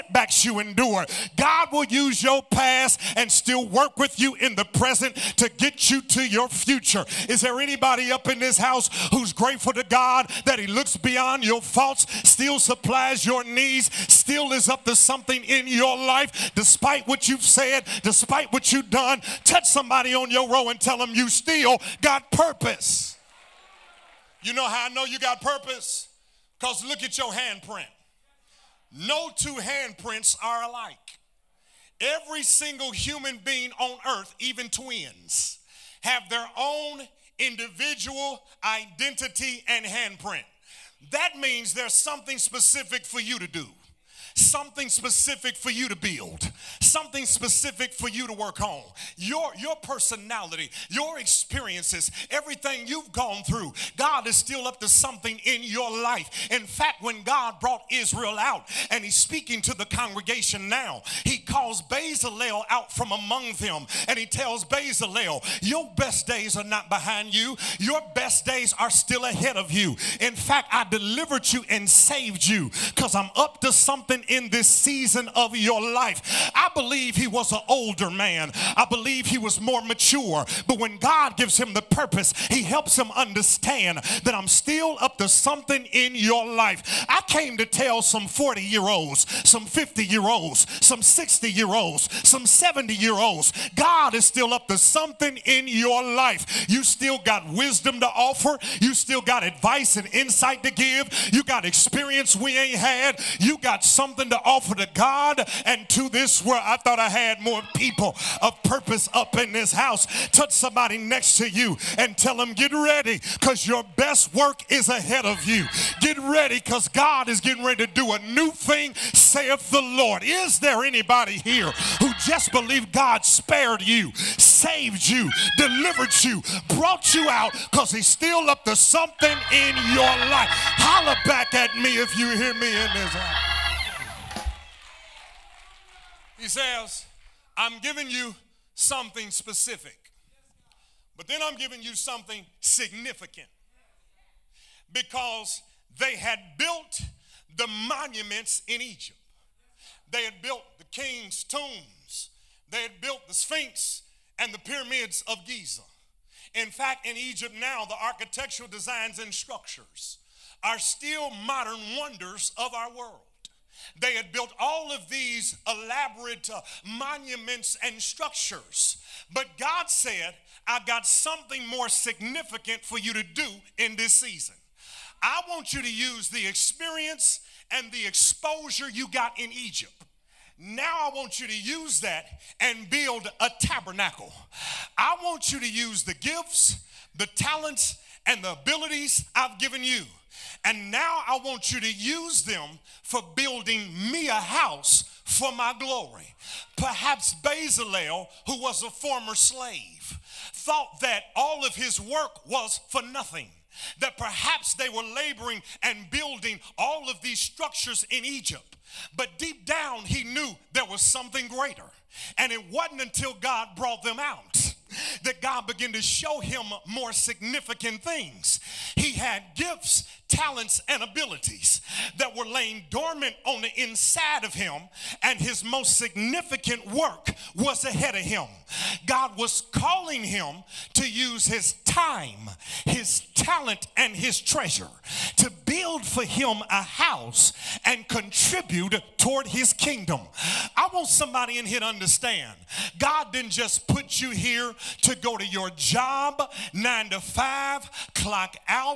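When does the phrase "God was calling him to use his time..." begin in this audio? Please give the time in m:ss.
3:49.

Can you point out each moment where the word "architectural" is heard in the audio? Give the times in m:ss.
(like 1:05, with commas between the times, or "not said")
2:37.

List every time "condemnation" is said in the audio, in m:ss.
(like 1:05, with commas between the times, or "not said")
not said.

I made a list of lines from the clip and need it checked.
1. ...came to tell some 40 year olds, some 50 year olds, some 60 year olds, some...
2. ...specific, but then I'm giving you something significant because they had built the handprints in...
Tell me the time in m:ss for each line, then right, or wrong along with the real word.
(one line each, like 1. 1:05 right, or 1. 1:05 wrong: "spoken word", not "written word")
1. 1:27 right
2. 2:19 wrong: "monuments", not "handprints".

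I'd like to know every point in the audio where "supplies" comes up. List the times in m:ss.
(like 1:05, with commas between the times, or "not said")
0:12.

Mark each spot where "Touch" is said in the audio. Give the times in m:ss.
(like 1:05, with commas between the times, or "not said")
0:19, 1:50.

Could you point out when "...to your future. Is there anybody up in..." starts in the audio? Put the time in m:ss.
0:06.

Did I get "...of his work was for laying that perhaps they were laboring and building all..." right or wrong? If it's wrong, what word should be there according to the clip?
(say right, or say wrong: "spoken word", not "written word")
wrong: "nothing", not "laying".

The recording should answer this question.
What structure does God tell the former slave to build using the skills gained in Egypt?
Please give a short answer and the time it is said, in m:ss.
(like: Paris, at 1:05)
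A tabernacle, at 3:03.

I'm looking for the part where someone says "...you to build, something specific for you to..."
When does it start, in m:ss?
0:45.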